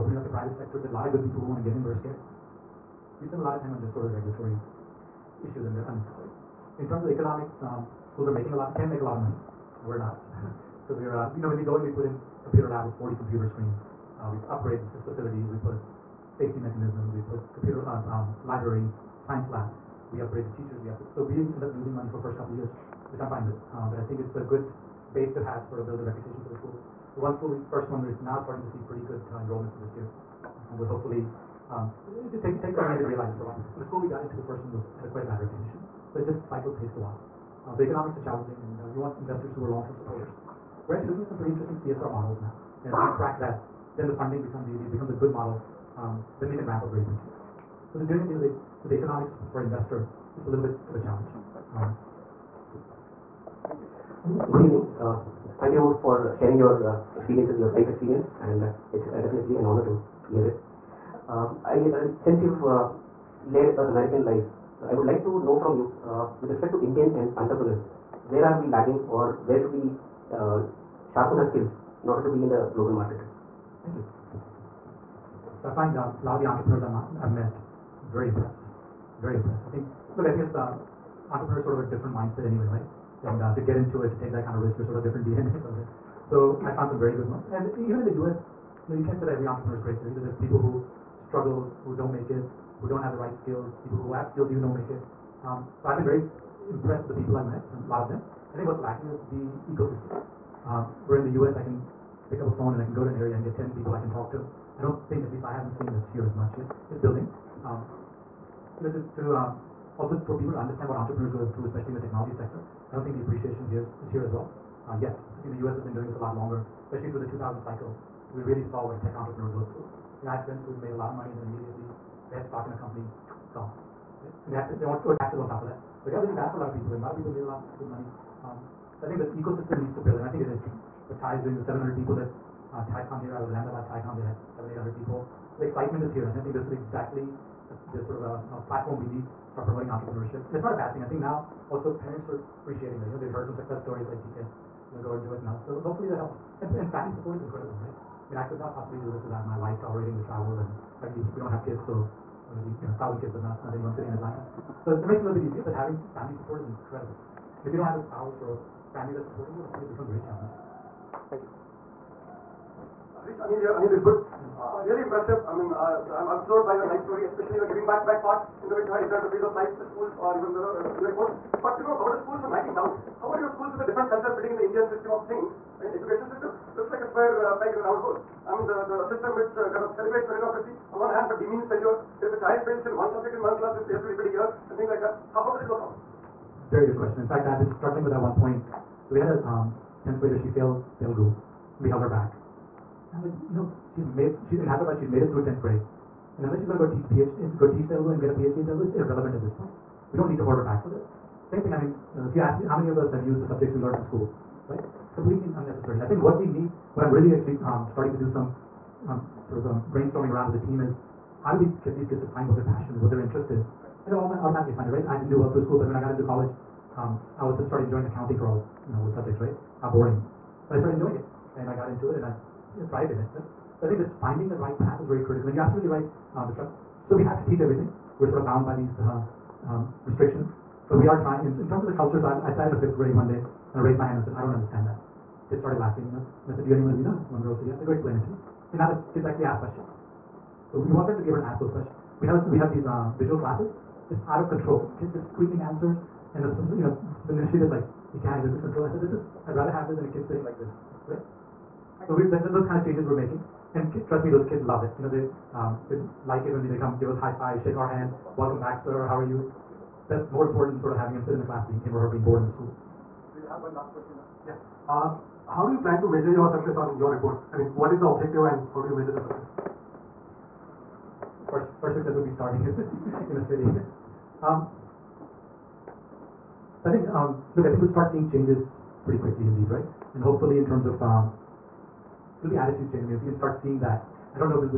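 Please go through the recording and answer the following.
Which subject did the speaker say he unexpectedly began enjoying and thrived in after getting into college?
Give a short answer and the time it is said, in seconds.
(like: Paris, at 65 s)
accounting, at 218 s.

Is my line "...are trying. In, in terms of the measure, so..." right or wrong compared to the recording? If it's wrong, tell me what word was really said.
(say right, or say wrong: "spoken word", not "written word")
wrong: "culture", not "measure".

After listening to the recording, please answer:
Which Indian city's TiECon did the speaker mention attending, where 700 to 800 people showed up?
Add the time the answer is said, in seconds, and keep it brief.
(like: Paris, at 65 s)
Ahmedabad, at 133 s.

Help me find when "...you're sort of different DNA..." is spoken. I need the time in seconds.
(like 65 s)
84 s.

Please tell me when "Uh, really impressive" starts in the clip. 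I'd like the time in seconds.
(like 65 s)
164 s.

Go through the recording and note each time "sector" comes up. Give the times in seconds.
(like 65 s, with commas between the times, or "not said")
0 s, 112 s.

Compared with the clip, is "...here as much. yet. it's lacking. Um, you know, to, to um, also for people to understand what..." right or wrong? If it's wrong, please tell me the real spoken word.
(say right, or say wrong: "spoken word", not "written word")
wrong: "building", not "lacking".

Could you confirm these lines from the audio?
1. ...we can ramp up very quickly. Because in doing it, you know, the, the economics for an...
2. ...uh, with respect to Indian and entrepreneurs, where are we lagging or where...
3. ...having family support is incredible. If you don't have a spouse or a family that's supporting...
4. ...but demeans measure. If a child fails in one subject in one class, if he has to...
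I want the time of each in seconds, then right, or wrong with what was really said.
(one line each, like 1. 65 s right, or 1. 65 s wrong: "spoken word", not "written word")
1. 46 s right
2. 66 s right
3. 155 s right
4. 181 s wrong: "failure", not "measure".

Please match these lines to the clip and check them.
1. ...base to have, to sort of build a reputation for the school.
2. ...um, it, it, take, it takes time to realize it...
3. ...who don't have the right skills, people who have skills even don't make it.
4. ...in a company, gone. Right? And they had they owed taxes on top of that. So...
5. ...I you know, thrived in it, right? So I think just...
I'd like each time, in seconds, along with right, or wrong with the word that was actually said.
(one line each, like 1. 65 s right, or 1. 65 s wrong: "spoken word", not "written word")
1. 25 s right
2. 31 s right
3. 92 s right
4. 122 s right
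5. 222 s right.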